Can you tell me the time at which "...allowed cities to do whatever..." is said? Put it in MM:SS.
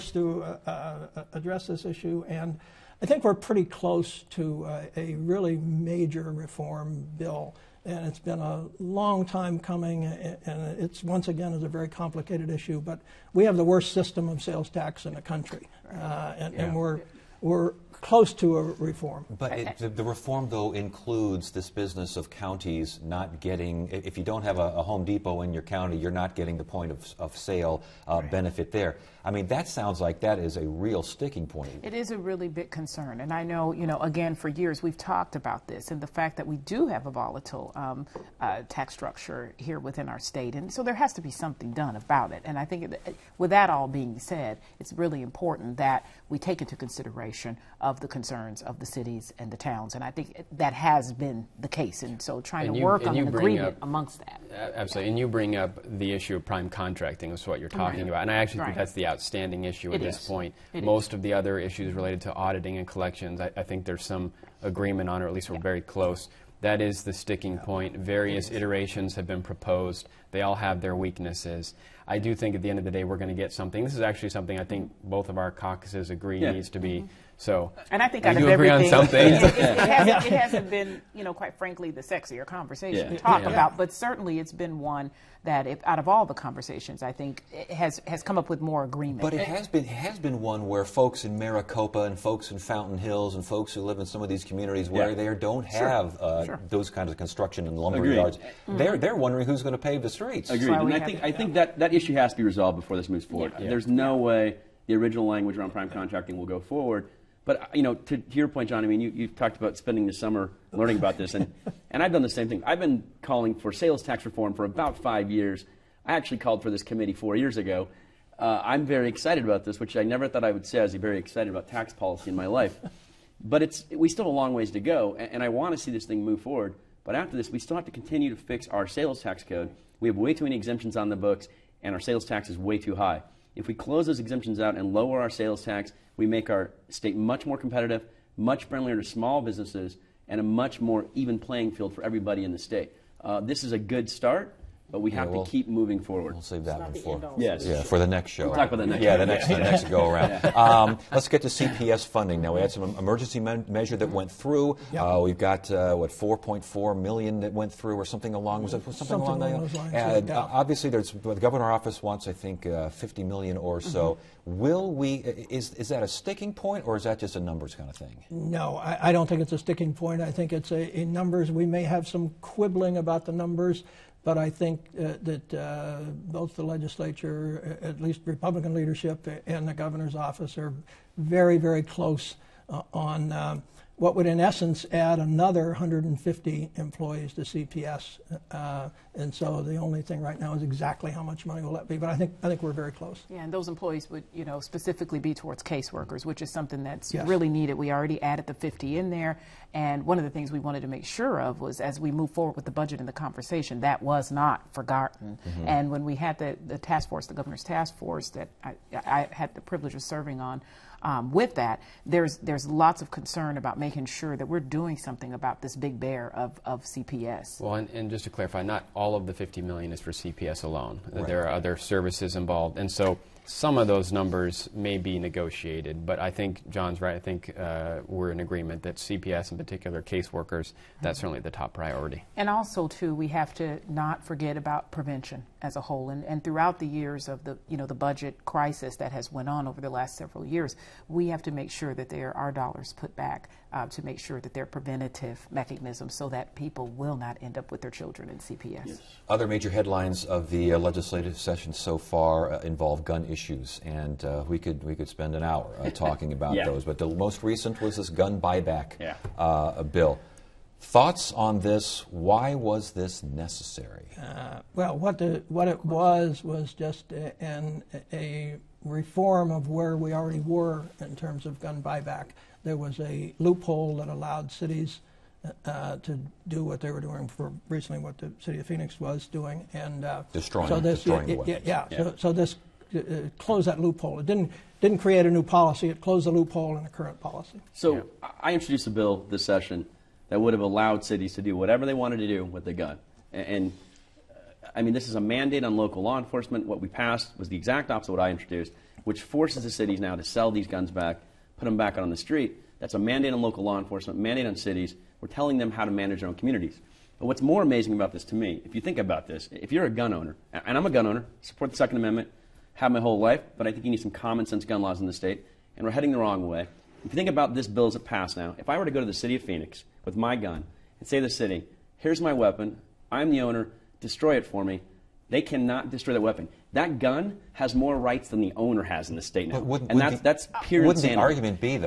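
04:50.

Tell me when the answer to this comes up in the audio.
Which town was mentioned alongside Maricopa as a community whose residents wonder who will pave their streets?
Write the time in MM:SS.
01:32.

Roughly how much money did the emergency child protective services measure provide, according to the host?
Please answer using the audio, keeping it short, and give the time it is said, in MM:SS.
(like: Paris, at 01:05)
4.4 million, at 02:36.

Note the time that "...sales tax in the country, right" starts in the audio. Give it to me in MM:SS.
00:14.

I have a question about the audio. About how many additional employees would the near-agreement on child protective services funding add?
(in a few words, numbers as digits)
150.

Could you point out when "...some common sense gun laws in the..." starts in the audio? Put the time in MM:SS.
05:13.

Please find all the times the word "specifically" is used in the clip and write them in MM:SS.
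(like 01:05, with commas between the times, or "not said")
03:14.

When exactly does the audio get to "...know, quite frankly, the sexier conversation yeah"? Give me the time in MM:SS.
01:21.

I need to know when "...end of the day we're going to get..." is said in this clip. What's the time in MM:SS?
01:12.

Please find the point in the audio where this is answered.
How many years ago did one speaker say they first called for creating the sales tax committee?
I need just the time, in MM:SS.
01:57.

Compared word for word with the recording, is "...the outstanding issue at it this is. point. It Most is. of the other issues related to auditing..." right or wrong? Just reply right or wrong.
right.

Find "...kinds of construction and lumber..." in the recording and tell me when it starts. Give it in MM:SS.
01:36.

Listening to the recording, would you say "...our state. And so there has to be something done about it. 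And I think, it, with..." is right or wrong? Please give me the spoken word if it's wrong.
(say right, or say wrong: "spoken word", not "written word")
right.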